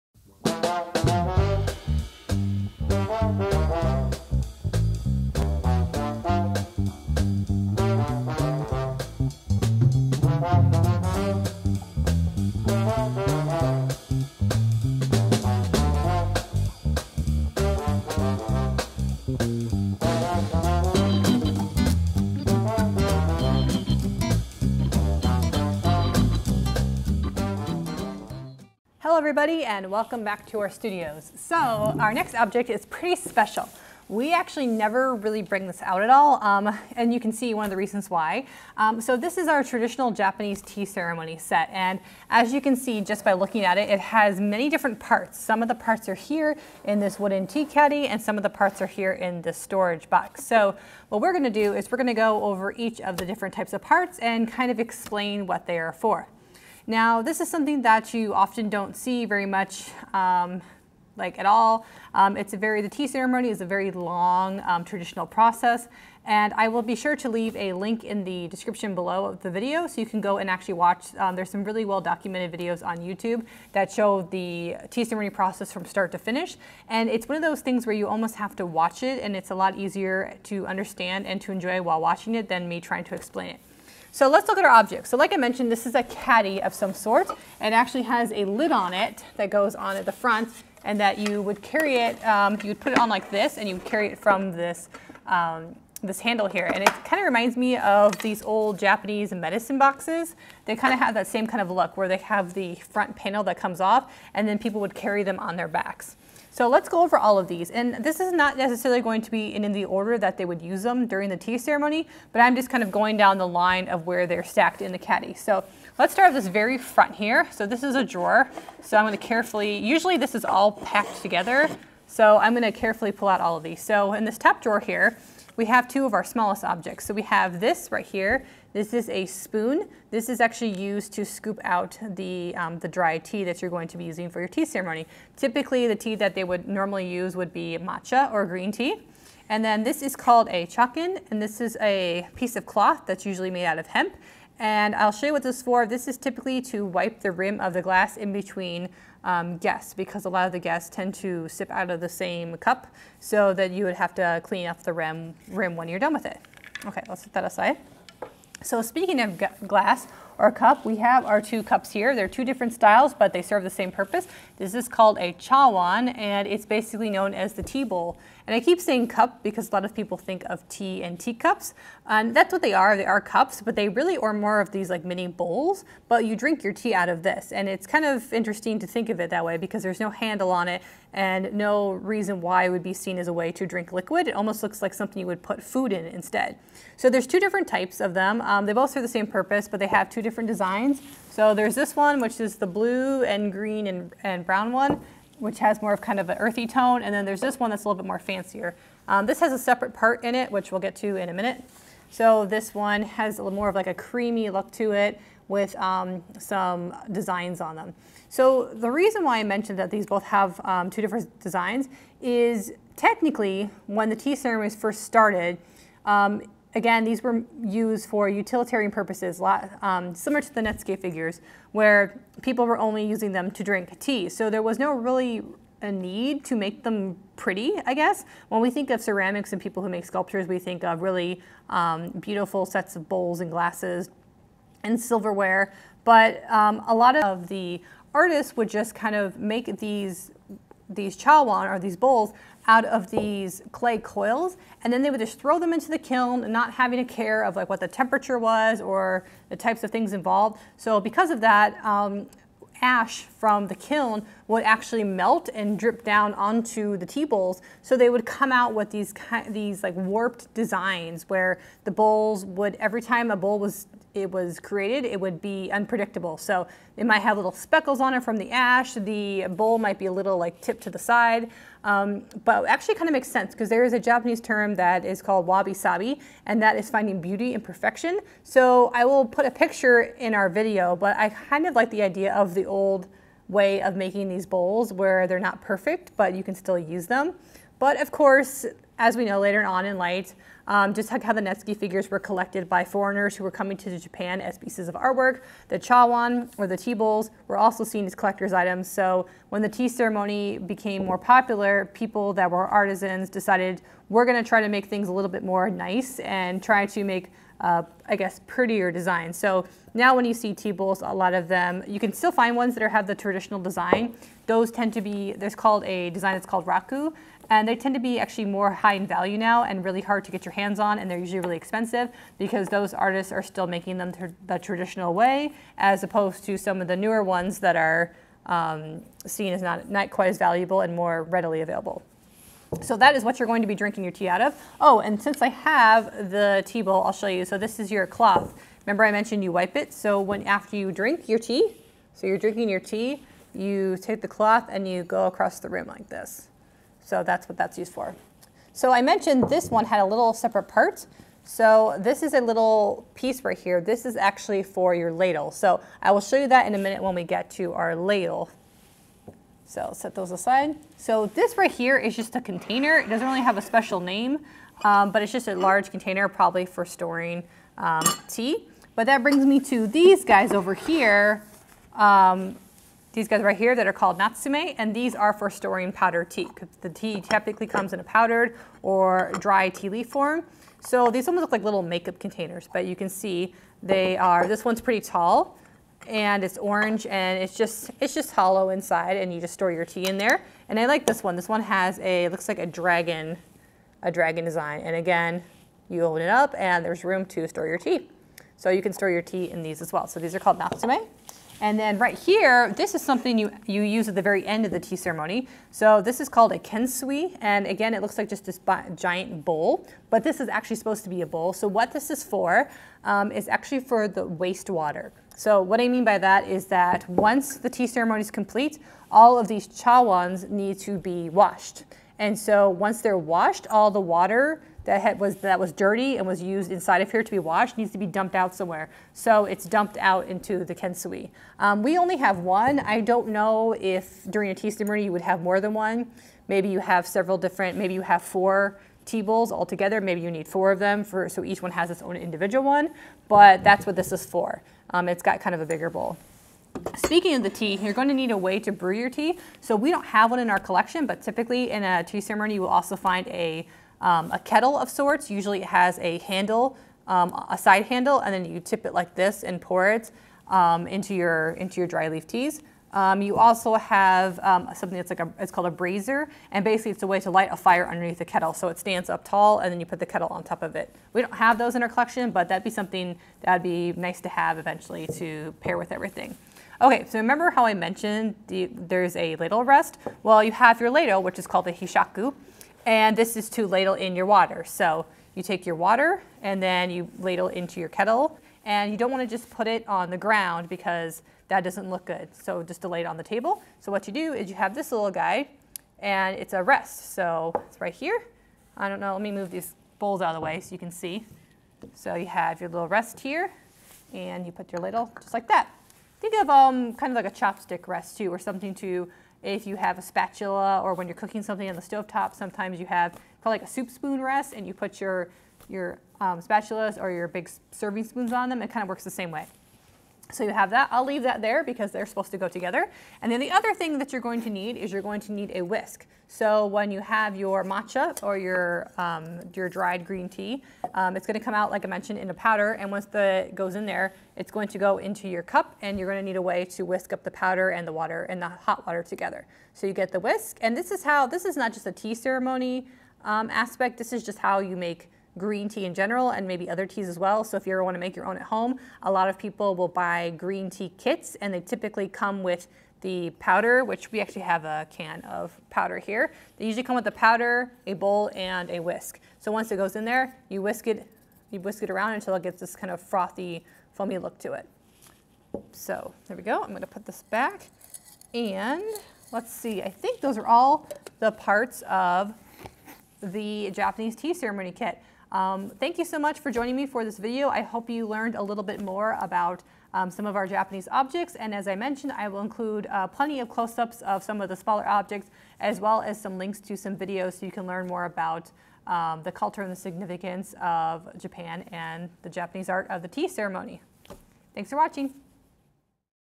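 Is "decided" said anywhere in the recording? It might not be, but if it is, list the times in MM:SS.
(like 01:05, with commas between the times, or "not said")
05:03.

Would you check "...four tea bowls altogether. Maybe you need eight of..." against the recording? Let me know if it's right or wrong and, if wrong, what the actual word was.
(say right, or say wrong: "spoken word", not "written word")
wrong: "four", not "eight".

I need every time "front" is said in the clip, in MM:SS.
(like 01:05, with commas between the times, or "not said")
01:30, 01:42, 01:56.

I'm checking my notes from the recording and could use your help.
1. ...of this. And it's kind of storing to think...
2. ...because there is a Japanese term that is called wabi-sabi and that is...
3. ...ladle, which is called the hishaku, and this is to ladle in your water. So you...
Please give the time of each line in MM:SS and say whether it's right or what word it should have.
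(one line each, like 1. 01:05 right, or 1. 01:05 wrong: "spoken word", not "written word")
1. 02:57 wrong: "interesting", not "storing"
2. 04:33 right
3. 08:00 right.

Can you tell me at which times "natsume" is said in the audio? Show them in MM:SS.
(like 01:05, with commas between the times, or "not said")
06:14, 06:40.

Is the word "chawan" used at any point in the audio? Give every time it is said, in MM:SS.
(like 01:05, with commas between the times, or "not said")
02:45, 04:01, 04:55, 06:59.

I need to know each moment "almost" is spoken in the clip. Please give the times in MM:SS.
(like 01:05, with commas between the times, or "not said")
01:18, 03:04, 06:21.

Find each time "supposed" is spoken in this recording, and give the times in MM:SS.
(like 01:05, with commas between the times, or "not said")
06:50, 08:42.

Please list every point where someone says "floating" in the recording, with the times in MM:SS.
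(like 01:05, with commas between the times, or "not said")
not said.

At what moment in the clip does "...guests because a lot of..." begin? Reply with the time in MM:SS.
02:29.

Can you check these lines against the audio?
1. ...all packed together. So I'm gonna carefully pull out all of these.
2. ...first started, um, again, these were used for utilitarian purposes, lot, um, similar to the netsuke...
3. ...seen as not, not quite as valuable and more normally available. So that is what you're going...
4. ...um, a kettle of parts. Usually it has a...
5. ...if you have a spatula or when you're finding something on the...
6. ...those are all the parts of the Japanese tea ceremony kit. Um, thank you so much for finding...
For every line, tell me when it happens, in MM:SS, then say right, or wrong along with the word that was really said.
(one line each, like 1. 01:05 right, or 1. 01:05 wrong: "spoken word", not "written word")
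1. 02:00 right
2. 03:34 right
3. 05:29 wrong: "readily", not "normally"
4. 07:34 wrong: "sorts", not "parts"
5. 08:29 wrong: "cooking", not "finding"
6. 09:30 wrong: "joining", not "finding".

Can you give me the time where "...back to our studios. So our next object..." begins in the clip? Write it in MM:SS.
00:30.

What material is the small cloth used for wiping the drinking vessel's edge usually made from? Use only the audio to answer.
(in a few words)
hemp.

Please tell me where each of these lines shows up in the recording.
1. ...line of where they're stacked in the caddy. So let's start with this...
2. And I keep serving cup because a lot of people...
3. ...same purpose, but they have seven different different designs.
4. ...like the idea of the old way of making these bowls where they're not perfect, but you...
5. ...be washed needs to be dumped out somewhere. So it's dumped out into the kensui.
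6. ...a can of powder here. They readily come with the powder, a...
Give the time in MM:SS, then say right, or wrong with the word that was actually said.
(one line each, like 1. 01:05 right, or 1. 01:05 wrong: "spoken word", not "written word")
1. 01:53 right
2. 02:48 wrong: "saying", not "serving"
3. 03:09 wrong: "two", not "seven"
4. 04:41 right
5. 07:07 right
6. 09:14 wrong: "usually", not "readily".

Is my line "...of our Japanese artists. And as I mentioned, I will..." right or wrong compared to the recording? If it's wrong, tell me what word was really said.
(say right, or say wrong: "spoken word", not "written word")
wrong: "objects", not "artists".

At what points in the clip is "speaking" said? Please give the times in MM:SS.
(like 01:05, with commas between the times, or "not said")
02:38, 07:26.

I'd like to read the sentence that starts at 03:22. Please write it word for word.
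So this one has a little more of like a creamy look to it with um, some designs on them.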